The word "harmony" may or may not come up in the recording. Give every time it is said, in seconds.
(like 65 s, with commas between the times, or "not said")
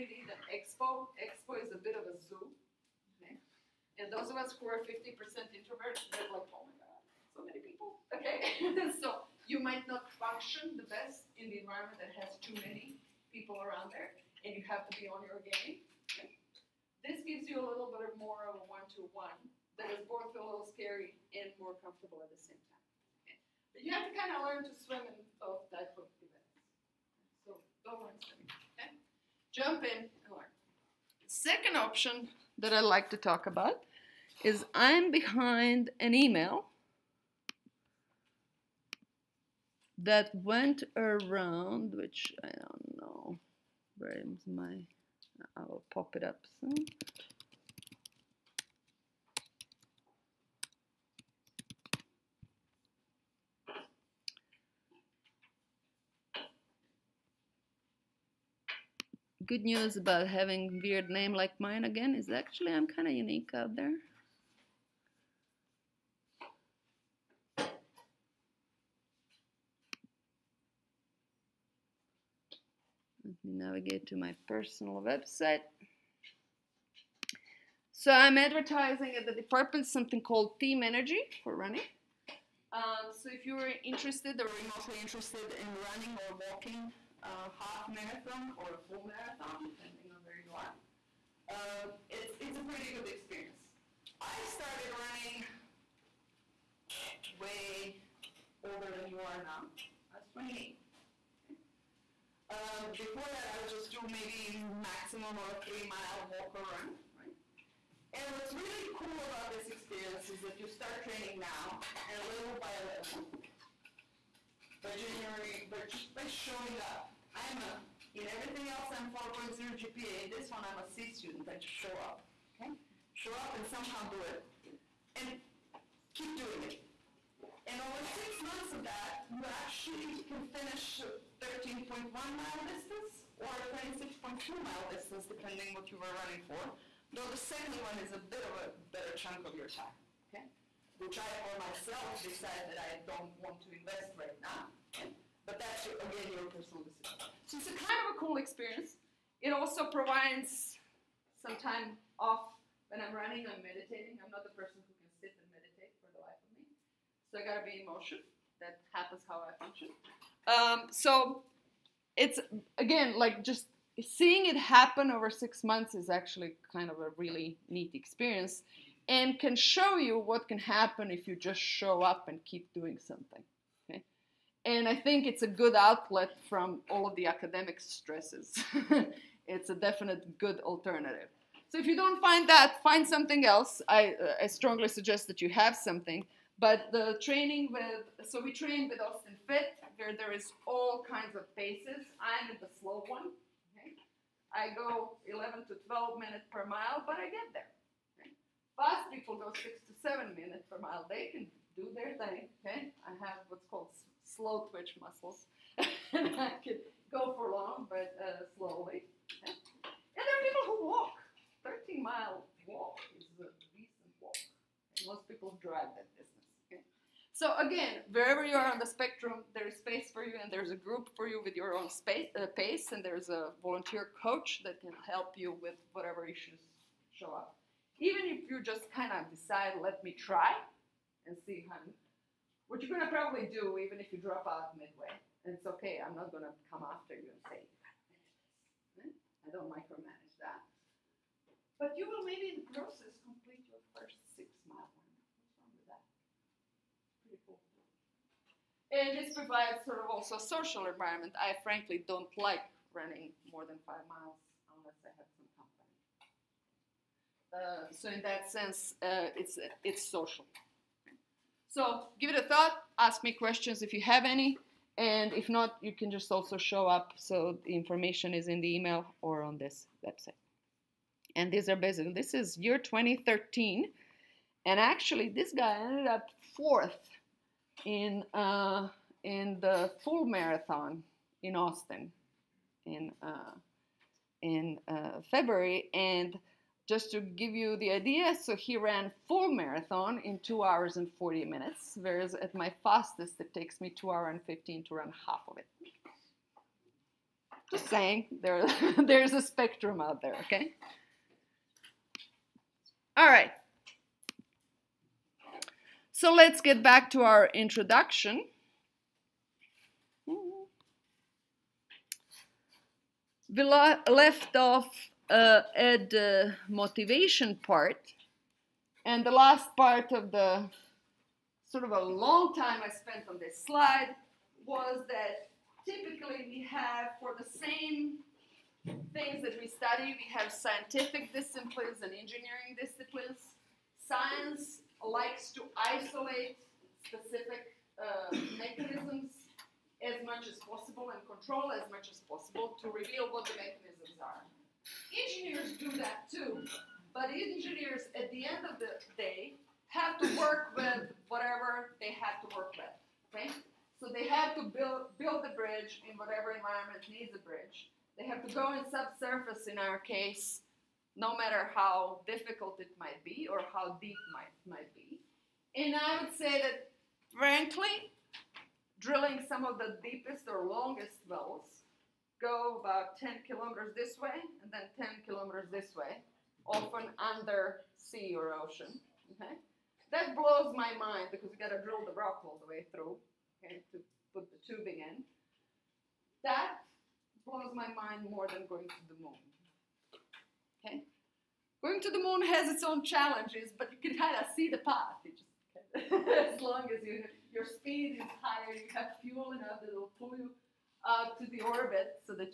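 not said.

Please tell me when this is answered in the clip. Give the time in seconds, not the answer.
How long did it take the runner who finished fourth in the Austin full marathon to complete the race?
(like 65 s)
290 s.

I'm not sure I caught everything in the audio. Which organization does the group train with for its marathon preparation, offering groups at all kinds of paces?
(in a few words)
Austin Fit.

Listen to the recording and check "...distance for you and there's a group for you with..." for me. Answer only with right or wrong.
wrong.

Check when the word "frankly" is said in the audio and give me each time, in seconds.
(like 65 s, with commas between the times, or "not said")
251 s, 367 s.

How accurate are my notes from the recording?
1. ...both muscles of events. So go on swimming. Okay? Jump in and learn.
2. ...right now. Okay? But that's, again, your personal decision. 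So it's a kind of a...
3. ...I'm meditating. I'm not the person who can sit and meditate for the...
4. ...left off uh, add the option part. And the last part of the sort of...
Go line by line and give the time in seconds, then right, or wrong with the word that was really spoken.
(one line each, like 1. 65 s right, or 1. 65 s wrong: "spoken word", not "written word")
1. 25 s wrong: "types", not "muscles"
2. 144 s right
3. 153 s right
4. 313 s wrong: "motivation", not "option".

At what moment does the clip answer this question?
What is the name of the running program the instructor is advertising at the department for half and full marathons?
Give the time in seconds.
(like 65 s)
80 s.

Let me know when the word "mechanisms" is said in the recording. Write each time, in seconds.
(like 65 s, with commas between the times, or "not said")
338 s, 343 s.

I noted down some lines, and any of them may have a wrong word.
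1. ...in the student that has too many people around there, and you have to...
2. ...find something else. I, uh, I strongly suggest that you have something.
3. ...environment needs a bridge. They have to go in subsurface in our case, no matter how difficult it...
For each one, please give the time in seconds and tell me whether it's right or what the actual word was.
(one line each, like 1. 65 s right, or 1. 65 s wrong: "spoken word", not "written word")
1. 11 s wrong: "environment", not "student"
2. 182 s right
3. 356 s right.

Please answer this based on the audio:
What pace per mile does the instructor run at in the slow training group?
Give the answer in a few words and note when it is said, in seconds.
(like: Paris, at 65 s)
11 to 12 minutes per mile, at 195 s.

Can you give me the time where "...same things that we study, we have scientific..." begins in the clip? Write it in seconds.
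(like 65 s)
327 s.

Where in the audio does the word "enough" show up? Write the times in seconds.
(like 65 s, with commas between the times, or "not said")
399 s.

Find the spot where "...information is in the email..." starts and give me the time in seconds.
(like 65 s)
267 s.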